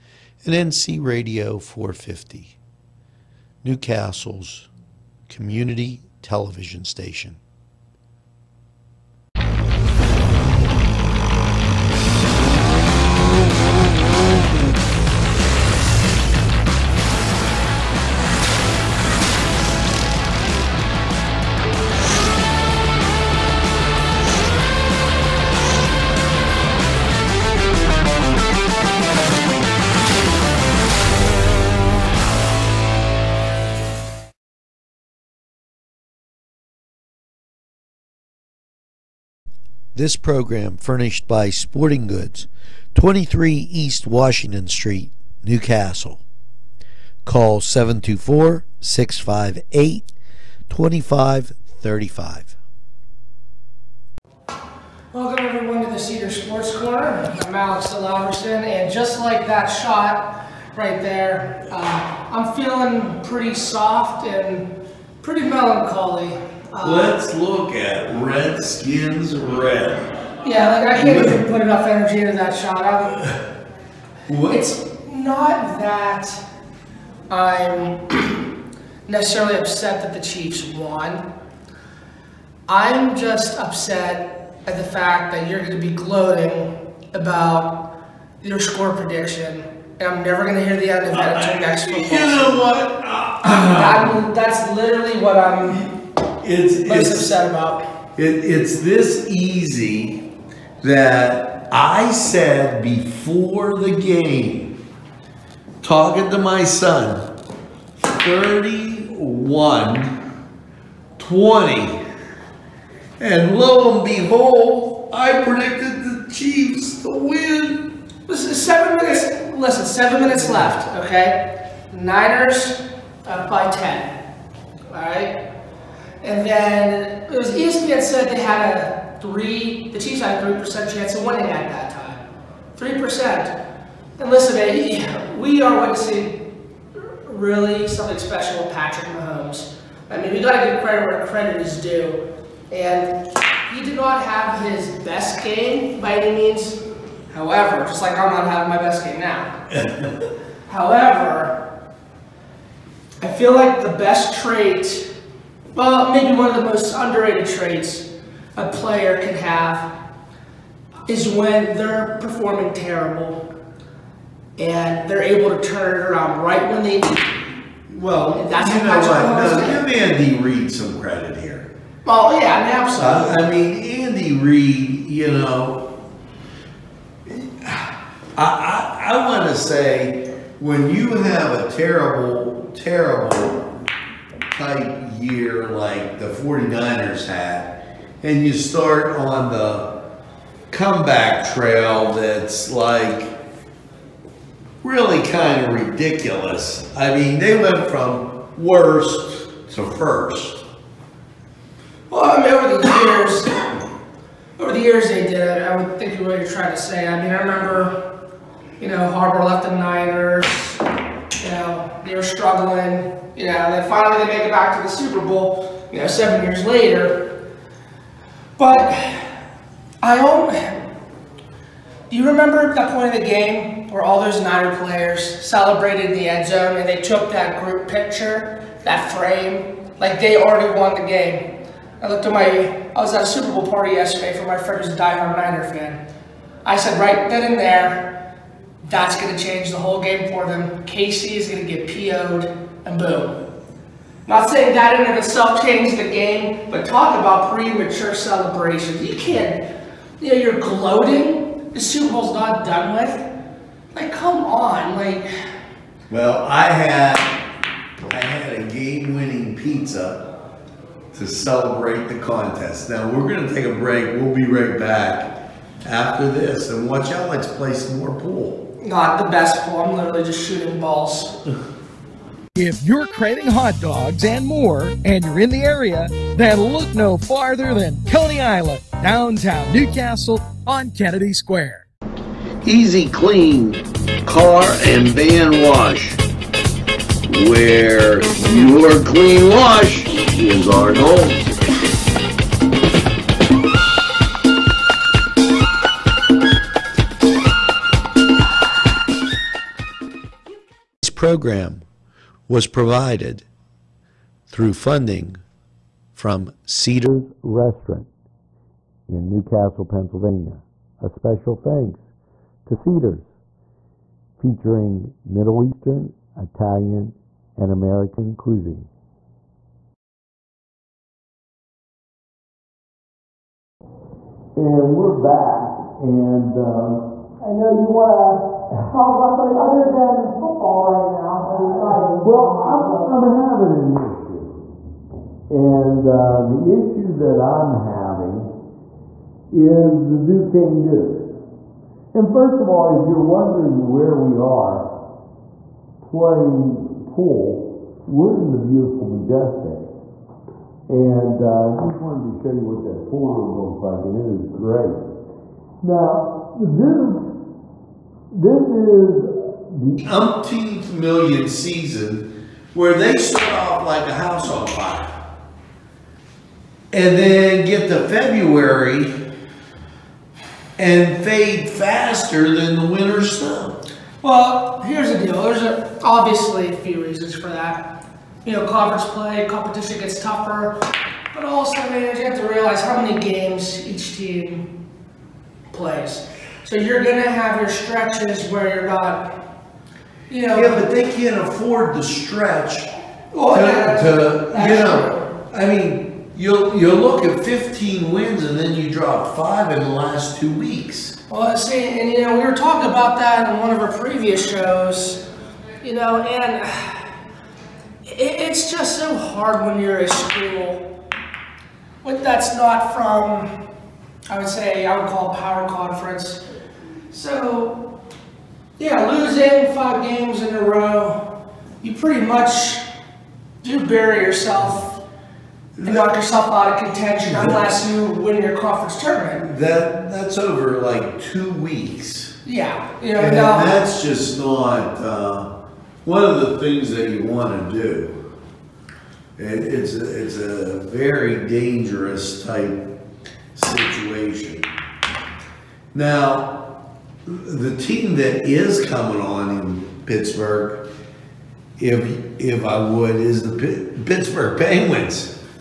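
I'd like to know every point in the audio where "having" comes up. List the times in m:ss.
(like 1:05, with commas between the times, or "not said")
2:28, 5:33, 5:37.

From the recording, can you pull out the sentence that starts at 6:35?
I mean, you'll you'll look at 15 wins and then you drop five in the last two weeks.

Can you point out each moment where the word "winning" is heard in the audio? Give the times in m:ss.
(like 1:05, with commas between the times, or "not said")
2:11, 4:18.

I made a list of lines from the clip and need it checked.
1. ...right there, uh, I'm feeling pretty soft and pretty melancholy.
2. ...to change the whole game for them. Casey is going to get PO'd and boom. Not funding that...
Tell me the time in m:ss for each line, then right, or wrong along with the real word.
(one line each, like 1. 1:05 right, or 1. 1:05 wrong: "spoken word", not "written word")
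1. 1:00 right
2. 3:59 wrong: "saying", not "funding".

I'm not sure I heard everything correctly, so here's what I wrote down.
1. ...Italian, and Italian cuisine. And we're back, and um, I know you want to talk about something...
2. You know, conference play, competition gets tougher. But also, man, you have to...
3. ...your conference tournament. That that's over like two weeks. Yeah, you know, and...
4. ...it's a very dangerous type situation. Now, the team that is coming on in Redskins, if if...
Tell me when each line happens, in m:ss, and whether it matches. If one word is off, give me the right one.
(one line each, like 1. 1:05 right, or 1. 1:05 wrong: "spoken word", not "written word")
1. 5:16 wrong: "American", not "Italian"
2. 6:18 right
3. 7:08 right
4. 7:20 wrong: "Pittsburgh", not "Redskins".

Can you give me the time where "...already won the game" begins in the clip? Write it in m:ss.
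3:50.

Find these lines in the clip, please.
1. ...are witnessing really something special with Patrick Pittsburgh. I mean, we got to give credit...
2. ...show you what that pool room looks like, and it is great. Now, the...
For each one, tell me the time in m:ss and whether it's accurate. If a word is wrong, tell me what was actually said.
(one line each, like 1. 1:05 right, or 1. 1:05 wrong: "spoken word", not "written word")
1. 2:15 wrong: "Mahomes", not "Pittsburgh"
2. 5:52 right.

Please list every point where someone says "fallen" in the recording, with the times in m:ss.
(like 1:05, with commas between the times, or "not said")
not said.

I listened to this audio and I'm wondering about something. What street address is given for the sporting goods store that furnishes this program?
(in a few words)
23 East Washington Street.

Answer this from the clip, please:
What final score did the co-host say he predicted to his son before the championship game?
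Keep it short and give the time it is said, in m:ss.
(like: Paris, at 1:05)
31-20, at 1:48.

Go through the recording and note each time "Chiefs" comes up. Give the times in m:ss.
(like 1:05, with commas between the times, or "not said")
1:20, 1:56, 2:09.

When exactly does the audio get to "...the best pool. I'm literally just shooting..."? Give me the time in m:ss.
4:29.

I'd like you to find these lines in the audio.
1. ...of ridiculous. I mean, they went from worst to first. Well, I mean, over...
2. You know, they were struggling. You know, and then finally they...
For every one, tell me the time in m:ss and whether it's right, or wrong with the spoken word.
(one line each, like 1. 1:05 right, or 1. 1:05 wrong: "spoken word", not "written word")
1. 3:15 right
2. 3:31 right.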